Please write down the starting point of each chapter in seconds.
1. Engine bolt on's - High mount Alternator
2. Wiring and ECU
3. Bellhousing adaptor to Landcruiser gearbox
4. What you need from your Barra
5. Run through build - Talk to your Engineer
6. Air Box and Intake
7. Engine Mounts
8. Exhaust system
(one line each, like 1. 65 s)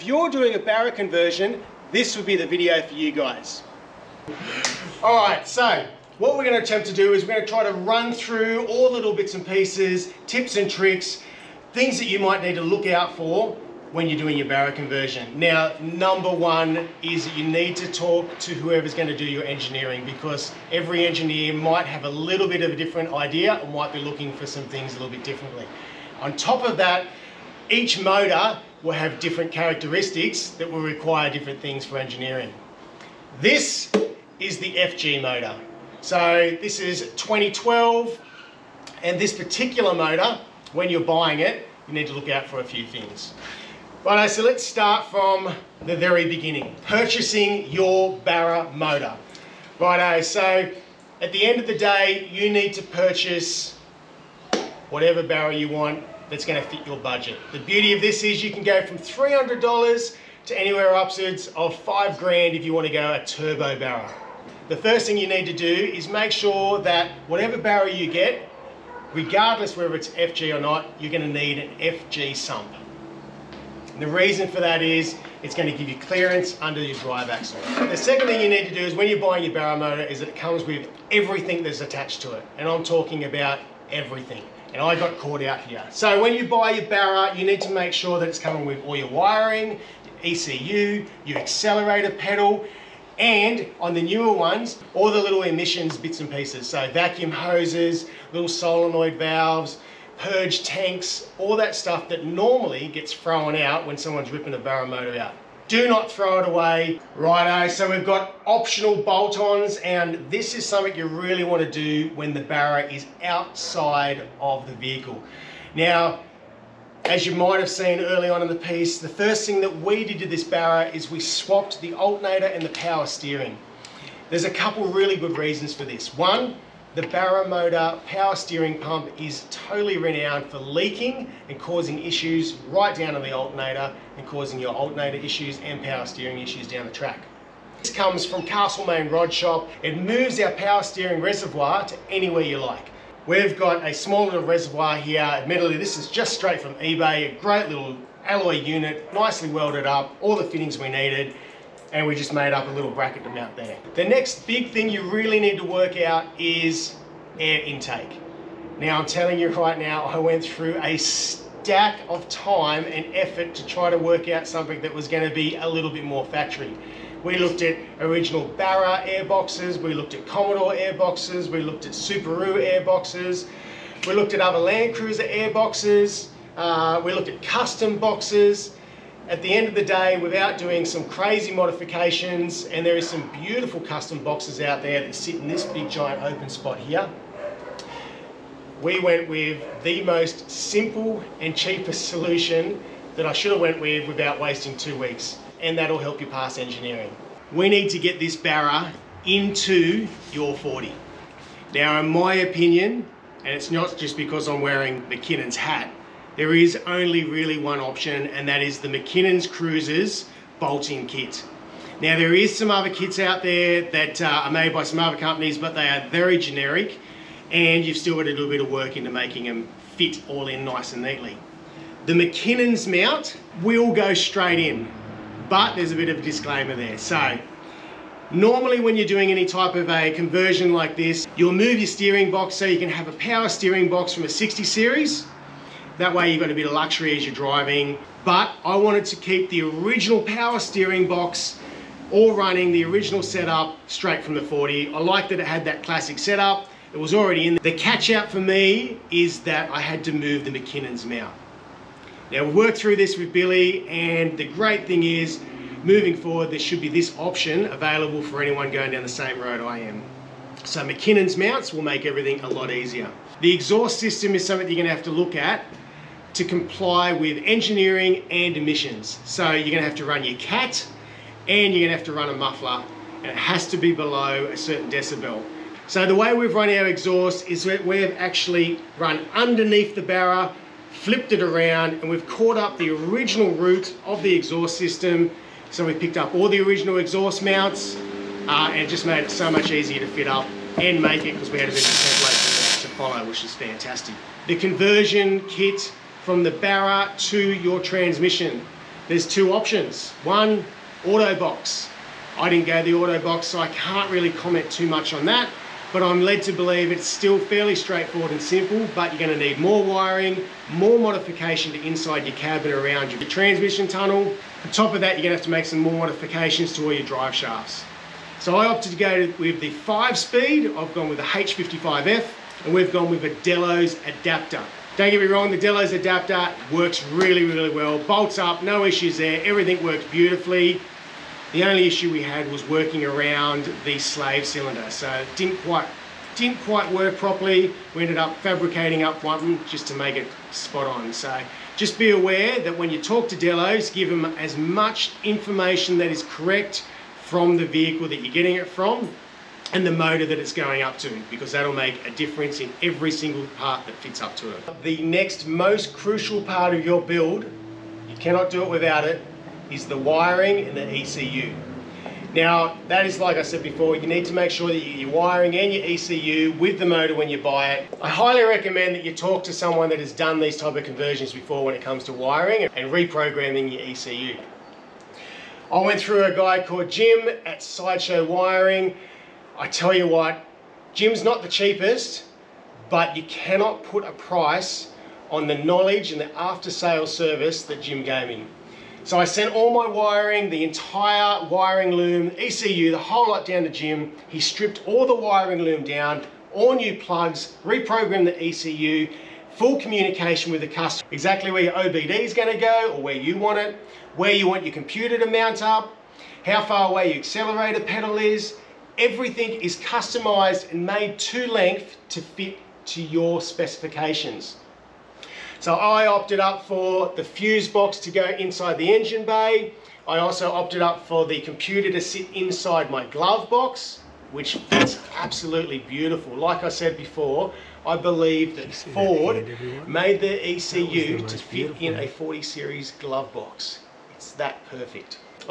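1. 109 s
2. 354 s
3. 294 s
4. 34 s
5. 9 s
6. 157 s
7. 194 s
8. 264 s.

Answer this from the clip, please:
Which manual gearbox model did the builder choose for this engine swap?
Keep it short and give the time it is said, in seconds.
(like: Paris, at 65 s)
H55F, at 321 s.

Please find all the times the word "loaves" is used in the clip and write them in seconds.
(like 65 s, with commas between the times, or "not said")
not said.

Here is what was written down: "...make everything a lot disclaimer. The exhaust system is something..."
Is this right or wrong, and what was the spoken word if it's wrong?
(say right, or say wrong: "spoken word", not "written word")
wrong: "easier", not "disclaimer".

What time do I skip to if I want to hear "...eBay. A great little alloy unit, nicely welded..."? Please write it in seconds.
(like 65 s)
146 s.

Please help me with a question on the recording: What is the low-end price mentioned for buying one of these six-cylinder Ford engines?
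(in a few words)
$300.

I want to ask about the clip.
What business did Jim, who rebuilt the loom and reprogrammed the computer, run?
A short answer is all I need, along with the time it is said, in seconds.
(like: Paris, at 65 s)
Sideshow Wiring, at 377 s.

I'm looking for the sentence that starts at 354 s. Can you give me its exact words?
The next most crucial part of your build, you cannot do it without it, is the wiring and the ECU.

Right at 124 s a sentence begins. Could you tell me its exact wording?
There's a couple really good reasons for this.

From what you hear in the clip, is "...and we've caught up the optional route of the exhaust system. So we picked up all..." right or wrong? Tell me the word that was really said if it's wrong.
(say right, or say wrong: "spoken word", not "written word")
wrong: "original", not "optional".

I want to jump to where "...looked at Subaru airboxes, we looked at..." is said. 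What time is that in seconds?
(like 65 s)
171 s.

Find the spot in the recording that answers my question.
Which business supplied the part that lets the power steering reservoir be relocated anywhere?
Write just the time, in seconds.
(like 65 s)
138 s.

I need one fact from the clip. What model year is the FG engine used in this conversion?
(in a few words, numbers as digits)
2012.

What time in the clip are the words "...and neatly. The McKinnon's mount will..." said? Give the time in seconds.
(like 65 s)
220 s.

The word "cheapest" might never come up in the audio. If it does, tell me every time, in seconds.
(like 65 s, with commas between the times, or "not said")
191 s, 381 s.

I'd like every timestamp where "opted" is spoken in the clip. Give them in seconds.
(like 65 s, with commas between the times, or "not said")
318 s, 416 s, 420 s.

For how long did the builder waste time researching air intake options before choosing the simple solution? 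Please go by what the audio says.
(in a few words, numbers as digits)
two weeks.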